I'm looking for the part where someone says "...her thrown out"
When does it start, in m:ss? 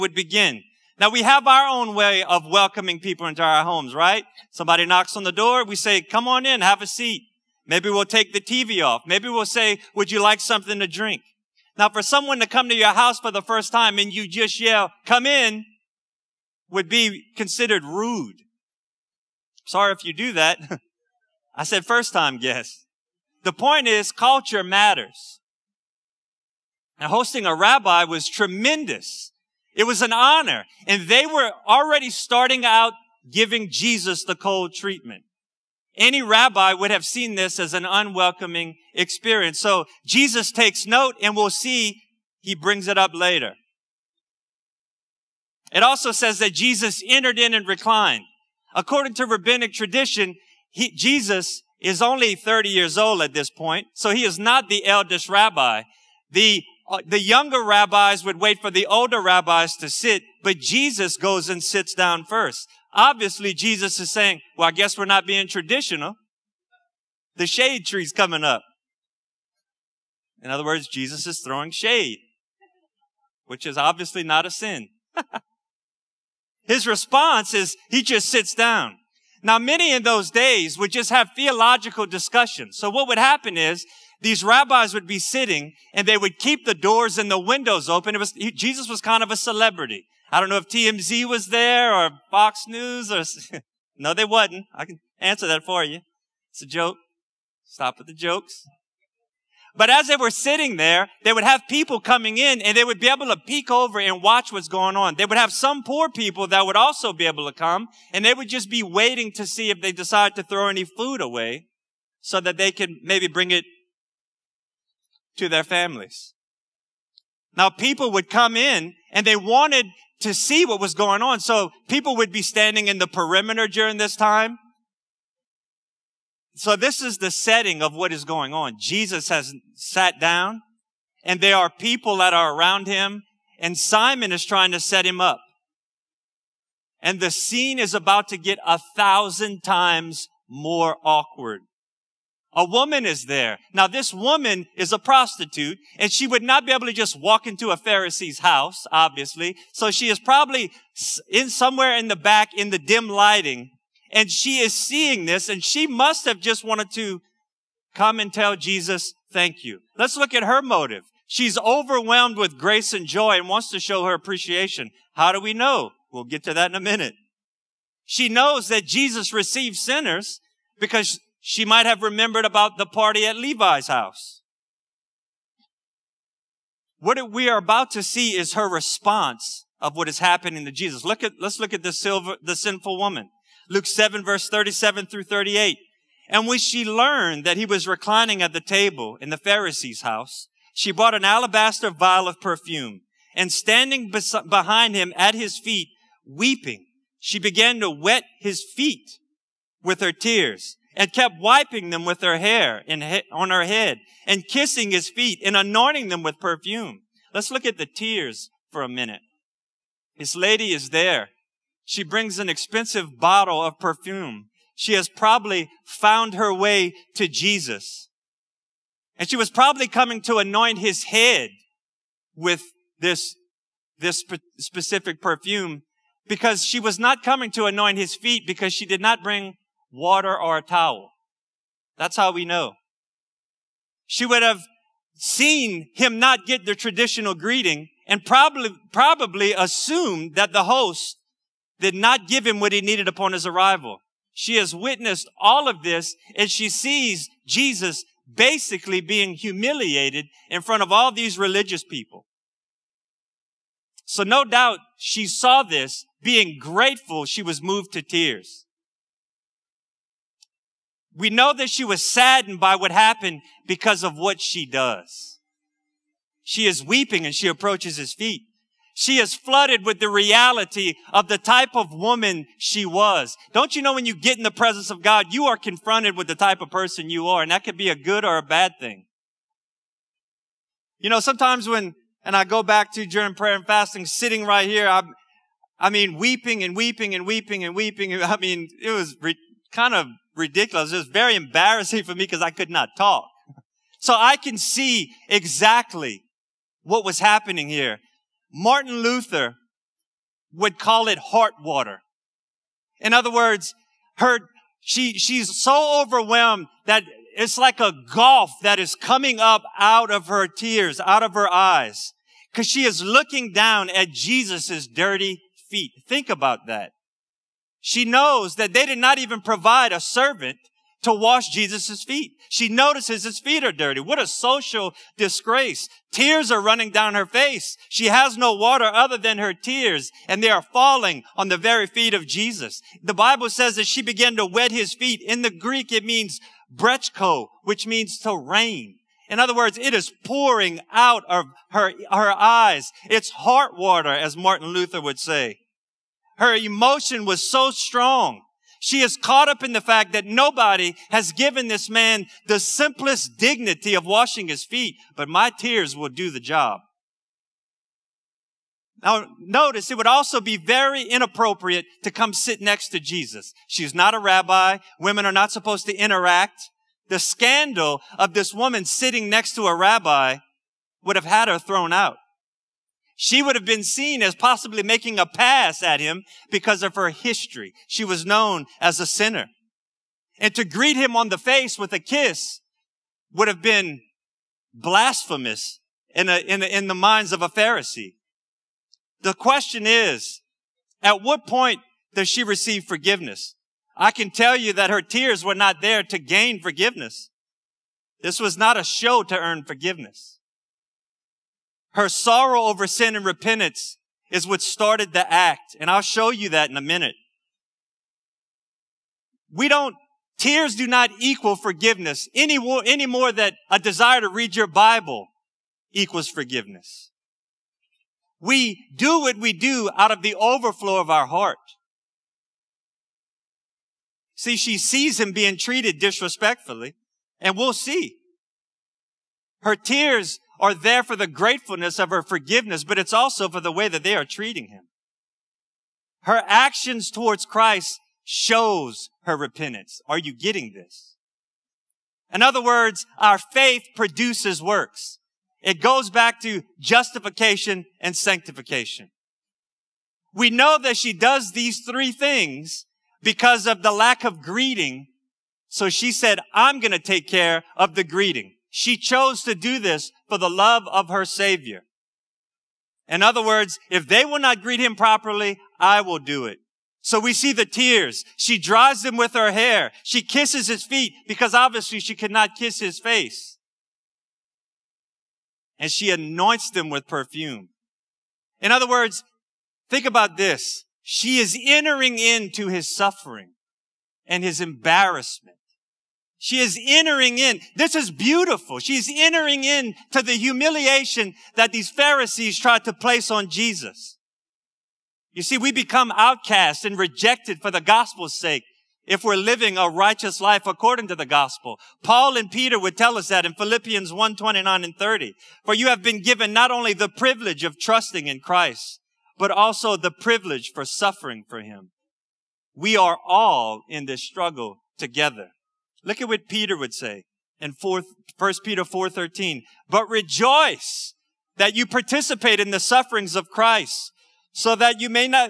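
6:11.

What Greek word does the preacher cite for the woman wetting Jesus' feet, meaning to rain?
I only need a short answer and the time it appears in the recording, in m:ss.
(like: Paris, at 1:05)
brechko, at 5:36.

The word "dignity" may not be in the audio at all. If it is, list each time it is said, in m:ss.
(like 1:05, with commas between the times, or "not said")
5:53.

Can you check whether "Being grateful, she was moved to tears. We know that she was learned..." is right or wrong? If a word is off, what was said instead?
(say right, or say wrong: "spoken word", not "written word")
wrong: "saddened", not "learned".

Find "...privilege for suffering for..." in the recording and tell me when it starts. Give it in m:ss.
8:30.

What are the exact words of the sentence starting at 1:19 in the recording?
Now, many in those days would just have theological discussions.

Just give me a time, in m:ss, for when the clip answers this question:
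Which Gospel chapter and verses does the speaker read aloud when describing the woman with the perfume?
3:03.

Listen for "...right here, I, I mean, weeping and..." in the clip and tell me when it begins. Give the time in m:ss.
4:44.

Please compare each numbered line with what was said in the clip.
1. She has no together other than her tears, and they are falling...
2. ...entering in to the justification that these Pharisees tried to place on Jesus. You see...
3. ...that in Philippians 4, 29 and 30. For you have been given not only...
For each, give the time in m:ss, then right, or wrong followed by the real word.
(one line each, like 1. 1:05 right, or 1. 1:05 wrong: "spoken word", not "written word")
1. 5:27 wrong: "water", not "together"
2. 8:09 wrong: "humiliation", not "justification"
3. 8:23 wrong: "1", not "4".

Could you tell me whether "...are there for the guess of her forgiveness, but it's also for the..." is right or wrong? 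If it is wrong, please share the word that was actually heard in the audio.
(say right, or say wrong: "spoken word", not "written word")
wrong: "gratefulness", not "guess".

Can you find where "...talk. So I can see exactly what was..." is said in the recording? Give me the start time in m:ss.
4:52.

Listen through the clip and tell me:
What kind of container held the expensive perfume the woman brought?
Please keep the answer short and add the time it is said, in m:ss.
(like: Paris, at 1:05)
Alabaster vial, at 3:11.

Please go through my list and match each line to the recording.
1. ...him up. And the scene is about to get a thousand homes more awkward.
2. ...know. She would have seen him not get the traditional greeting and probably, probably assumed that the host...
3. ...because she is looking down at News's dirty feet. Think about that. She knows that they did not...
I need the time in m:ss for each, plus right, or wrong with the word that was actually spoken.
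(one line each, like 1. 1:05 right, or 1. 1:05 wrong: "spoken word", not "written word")
1. 2:15 wrong: "times", not "homes"
2. 3:52 right
3. 5:12 wrong: "Jesus", not "News".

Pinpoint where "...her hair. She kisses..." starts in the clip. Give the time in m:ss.
7:49.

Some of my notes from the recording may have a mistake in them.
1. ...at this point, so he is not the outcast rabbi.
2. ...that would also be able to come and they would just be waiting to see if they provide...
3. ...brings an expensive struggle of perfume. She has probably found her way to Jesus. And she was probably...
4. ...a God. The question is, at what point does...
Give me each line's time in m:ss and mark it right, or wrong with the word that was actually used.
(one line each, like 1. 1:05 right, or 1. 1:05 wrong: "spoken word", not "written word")
1. 0:53 wrong: "eldest", not "outcast"
2. 1:46 wrong: "decide", not "provide"
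3. 3:32 wrong: "bottle", not "struggle"
4. 6:27 wrong: "Pharisee", not "God".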